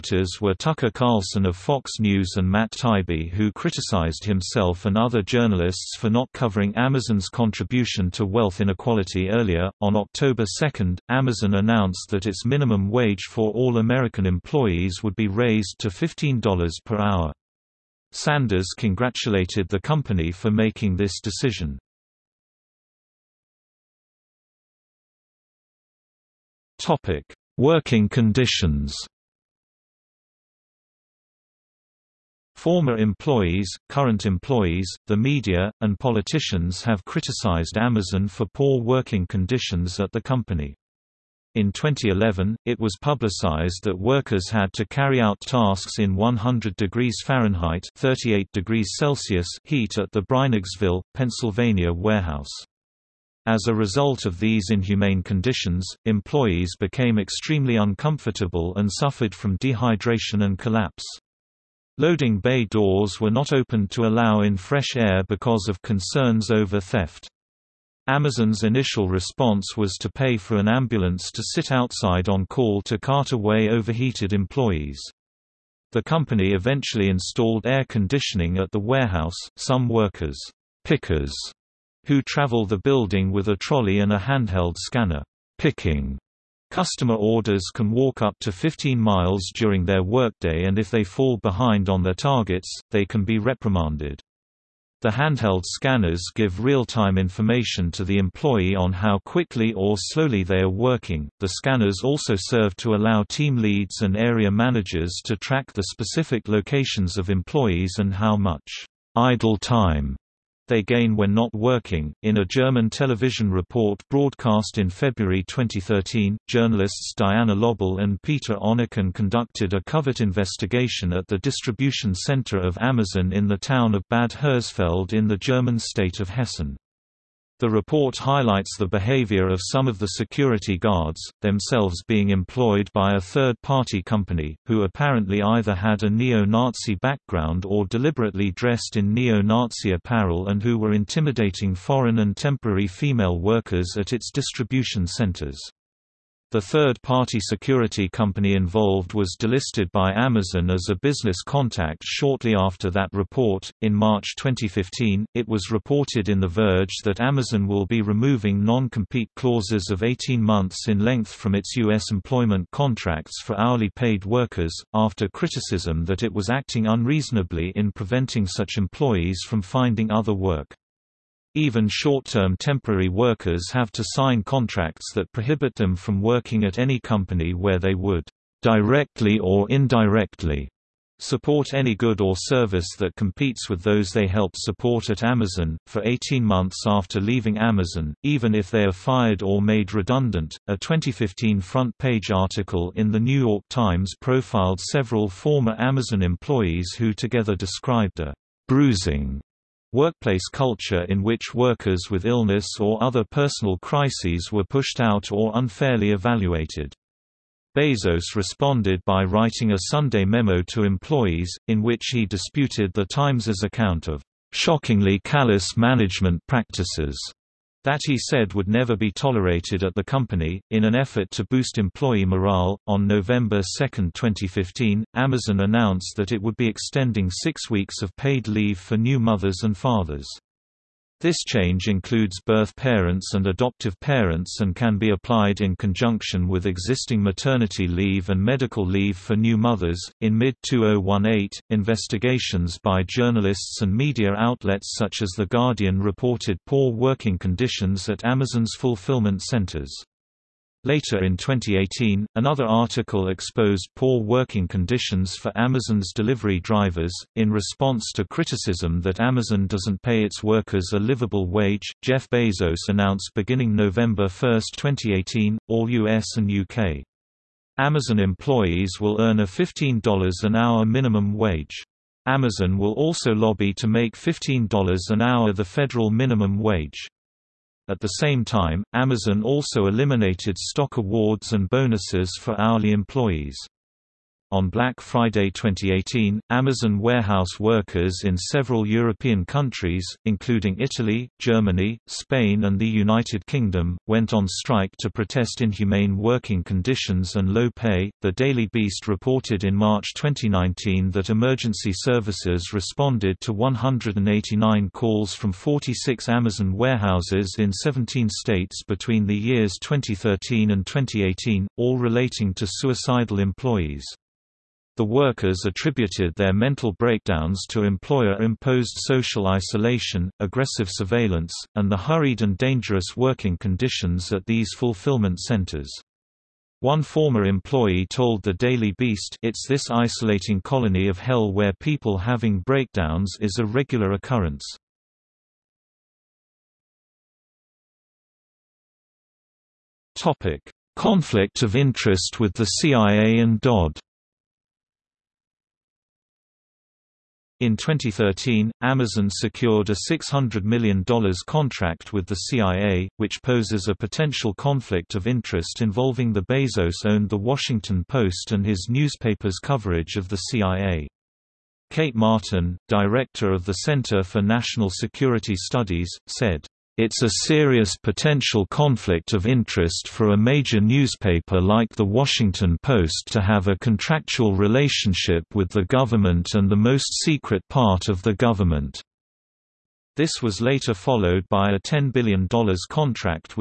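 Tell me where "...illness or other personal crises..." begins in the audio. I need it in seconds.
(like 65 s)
202 s.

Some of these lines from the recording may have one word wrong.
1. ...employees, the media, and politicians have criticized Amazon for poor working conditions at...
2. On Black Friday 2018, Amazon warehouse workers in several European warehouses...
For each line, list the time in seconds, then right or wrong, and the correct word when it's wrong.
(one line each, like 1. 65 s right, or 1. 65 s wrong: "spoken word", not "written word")
1. 34 s right
2. 284 s wrong: "countries", not "warehouses".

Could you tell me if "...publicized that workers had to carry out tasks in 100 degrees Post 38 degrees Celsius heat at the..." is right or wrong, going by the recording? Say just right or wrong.
wrong.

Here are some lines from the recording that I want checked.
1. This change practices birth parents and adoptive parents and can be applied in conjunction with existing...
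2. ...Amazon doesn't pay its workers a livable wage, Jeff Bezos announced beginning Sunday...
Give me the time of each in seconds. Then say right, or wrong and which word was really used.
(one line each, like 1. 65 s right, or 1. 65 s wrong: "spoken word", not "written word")
1. 231 s wrong: "includes", not "practices"
2. 259 s wrong: "November", not "Sunday".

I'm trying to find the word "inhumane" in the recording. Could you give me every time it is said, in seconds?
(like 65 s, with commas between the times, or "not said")
54 s, 295 s.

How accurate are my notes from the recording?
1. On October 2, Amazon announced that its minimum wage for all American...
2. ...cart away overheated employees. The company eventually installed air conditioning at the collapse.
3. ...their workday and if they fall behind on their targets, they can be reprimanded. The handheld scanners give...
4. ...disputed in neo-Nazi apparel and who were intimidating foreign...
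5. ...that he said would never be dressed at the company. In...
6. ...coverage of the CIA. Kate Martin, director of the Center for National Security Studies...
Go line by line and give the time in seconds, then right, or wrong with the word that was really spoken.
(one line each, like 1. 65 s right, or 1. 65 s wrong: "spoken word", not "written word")
1. 9 s right
2. 72 s wrong: "warehouse", not "collapse"
3. 89 s right
4. 138 s wrong: "dressed", not "disputed"
5. 217 s wrong: "tolerated", not "dressed"
6. 359 s right.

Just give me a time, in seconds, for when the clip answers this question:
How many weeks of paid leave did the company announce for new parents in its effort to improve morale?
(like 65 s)
227 s.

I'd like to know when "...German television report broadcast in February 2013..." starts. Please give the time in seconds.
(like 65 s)
112 s.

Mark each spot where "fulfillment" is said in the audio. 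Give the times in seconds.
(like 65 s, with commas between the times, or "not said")
248 s, 324 s.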